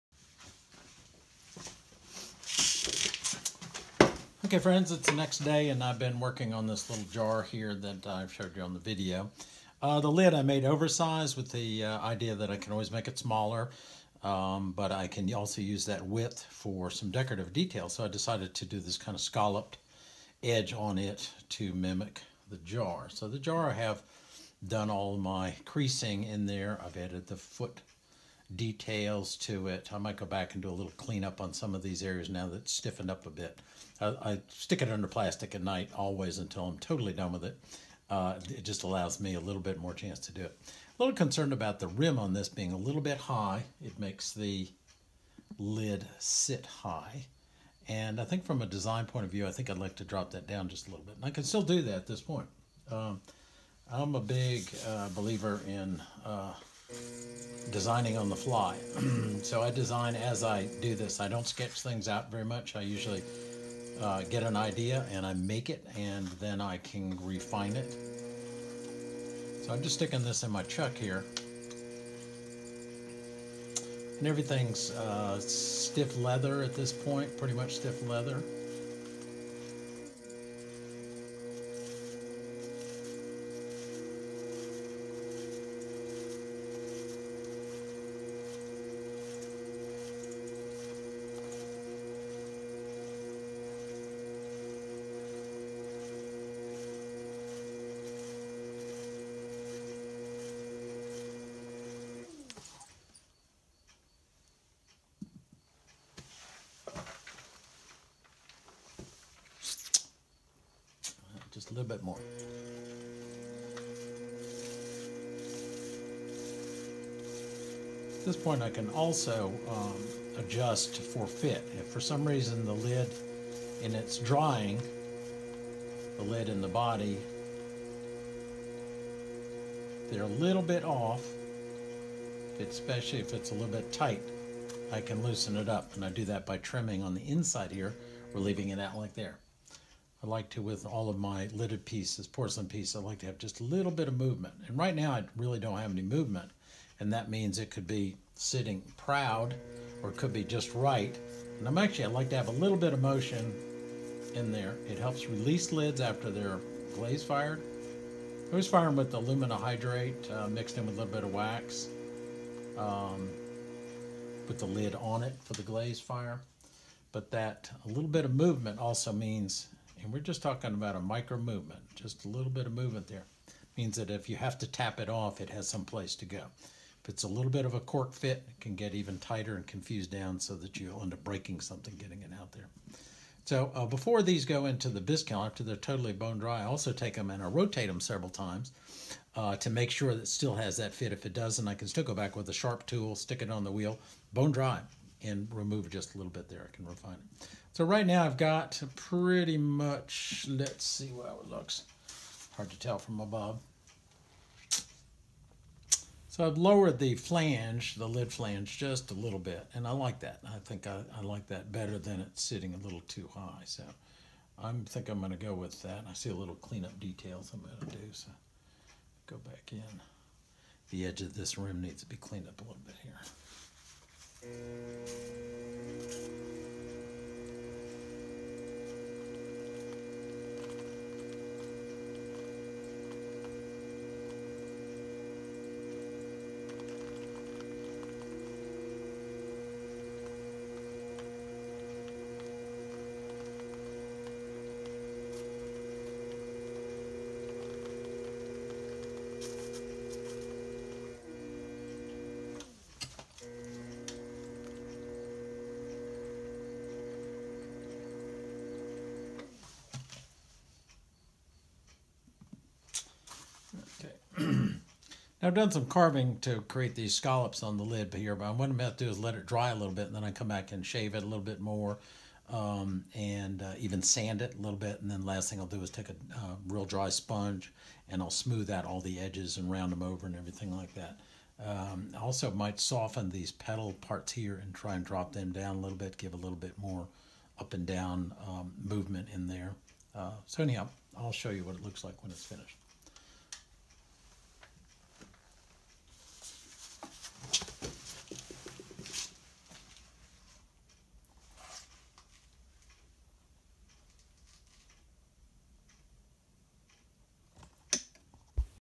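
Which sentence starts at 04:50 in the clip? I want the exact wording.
Uh, so anyhow, I'll show you what it looks like when it's finished.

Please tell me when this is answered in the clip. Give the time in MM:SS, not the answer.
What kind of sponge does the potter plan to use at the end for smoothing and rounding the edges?
04:36.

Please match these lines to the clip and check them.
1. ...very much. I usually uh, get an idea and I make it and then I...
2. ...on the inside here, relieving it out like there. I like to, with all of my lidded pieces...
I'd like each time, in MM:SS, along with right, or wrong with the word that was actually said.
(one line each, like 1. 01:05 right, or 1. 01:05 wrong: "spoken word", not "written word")
1. 01:02 right
2. 02:17 right.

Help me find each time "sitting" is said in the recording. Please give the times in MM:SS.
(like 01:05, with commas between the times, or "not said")
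02:28, 03:32.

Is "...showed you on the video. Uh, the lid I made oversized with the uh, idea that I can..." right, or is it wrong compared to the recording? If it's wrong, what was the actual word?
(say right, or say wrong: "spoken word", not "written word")
right.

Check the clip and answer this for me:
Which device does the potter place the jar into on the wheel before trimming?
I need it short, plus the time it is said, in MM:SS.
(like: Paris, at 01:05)
chuck, at 01:10.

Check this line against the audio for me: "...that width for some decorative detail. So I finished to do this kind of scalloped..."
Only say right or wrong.
wrong.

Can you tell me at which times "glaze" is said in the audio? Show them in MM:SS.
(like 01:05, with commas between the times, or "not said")
02:36, 02:45.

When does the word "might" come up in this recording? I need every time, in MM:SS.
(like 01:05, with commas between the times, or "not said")
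00:29, 04:42.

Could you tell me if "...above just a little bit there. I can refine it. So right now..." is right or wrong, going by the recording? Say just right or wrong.
wrong.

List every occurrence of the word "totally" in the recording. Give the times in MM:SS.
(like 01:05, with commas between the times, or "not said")
00:36, 03:05.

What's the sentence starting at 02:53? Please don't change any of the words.
Means that if you have to tap it off, it has some place to go.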